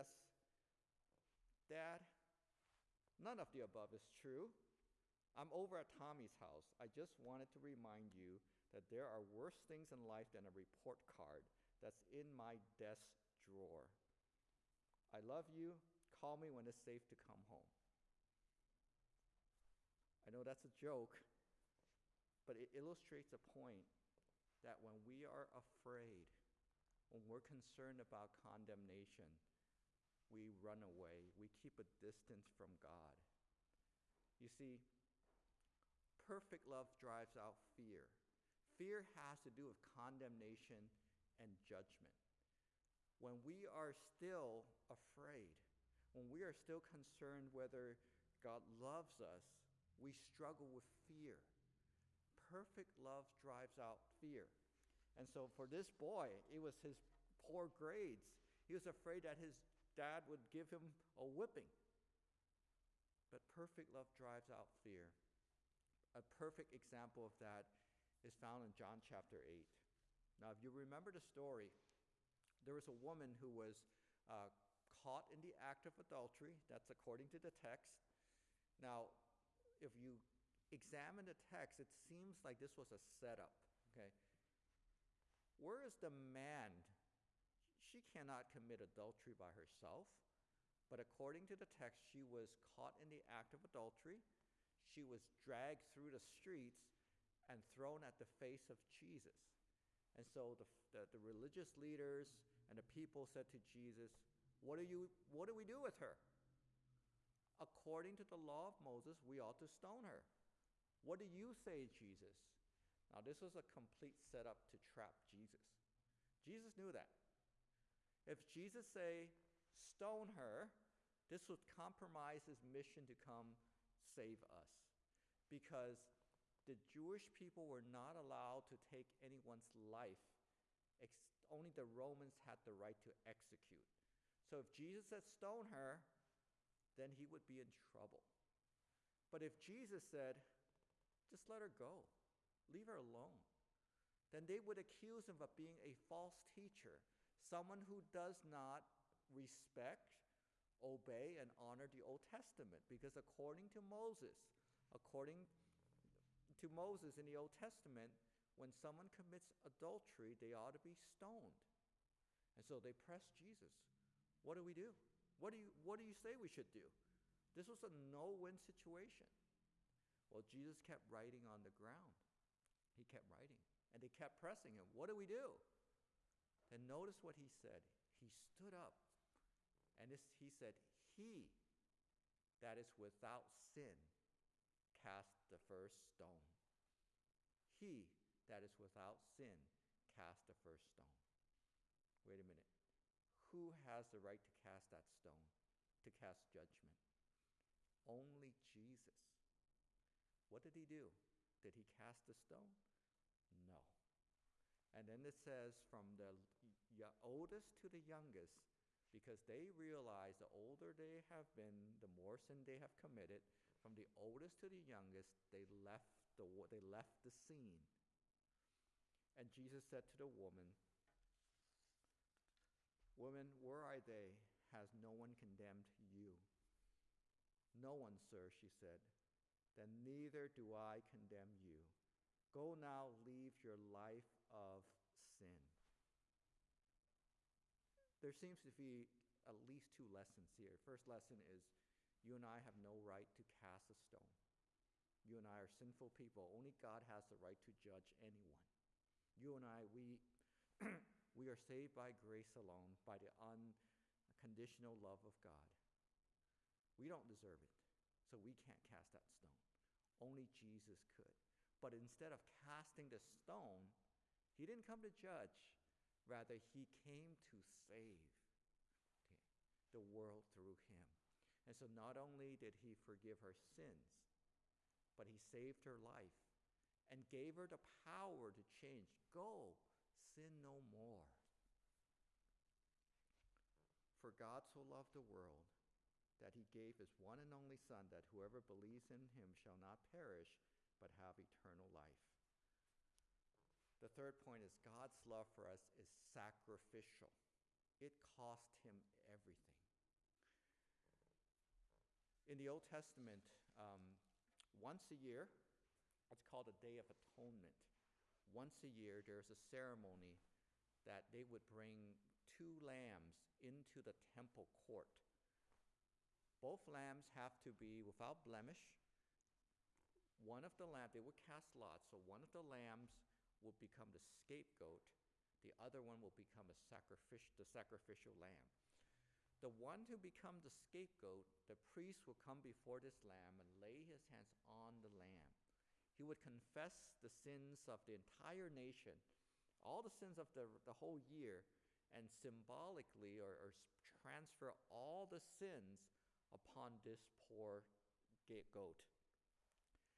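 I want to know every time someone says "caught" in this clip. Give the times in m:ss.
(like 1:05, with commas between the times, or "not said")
1:14, 1:32.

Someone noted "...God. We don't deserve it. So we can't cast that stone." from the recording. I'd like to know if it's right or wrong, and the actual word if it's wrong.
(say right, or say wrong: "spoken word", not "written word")
right.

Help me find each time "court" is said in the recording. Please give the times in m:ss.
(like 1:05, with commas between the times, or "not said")
5:14.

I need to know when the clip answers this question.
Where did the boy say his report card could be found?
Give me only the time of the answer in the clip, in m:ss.
0:12.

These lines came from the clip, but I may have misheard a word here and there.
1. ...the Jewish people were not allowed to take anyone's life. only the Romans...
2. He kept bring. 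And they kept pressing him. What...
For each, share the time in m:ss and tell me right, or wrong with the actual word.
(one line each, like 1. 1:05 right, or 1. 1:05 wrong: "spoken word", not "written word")
1. 2:06 right
2. 2:52 wrong: "writing", not "bring".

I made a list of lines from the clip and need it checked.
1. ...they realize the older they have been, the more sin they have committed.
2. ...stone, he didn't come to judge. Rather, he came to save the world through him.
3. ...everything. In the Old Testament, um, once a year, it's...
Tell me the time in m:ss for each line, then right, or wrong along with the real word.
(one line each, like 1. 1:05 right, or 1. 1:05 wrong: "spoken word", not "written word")
1. 3:29 right
2. 4:23 right
3. 4:59 right.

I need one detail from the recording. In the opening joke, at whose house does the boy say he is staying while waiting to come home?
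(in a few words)
Tommy's house.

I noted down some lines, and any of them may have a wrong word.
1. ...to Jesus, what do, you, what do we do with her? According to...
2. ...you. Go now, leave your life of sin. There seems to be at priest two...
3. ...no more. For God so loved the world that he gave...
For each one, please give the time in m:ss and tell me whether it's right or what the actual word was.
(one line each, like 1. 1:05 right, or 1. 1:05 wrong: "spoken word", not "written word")
1. 1:43 right
2. 3:51 wrong: "least", not "priest"
3. 4:40 right.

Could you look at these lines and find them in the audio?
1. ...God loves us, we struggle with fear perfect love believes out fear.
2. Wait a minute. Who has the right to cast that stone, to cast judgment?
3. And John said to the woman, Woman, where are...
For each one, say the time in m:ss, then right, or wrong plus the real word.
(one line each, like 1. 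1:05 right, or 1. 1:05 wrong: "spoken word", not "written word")
1. 0:48 wrong: "drives", not "believes"
2. 3:12 right
3. 3:39 wrong: "Jesus", not "John".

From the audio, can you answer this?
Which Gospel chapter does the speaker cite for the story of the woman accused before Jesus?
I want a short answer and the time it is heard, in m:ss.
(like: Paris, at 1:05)
John chapter 8, at 1:08.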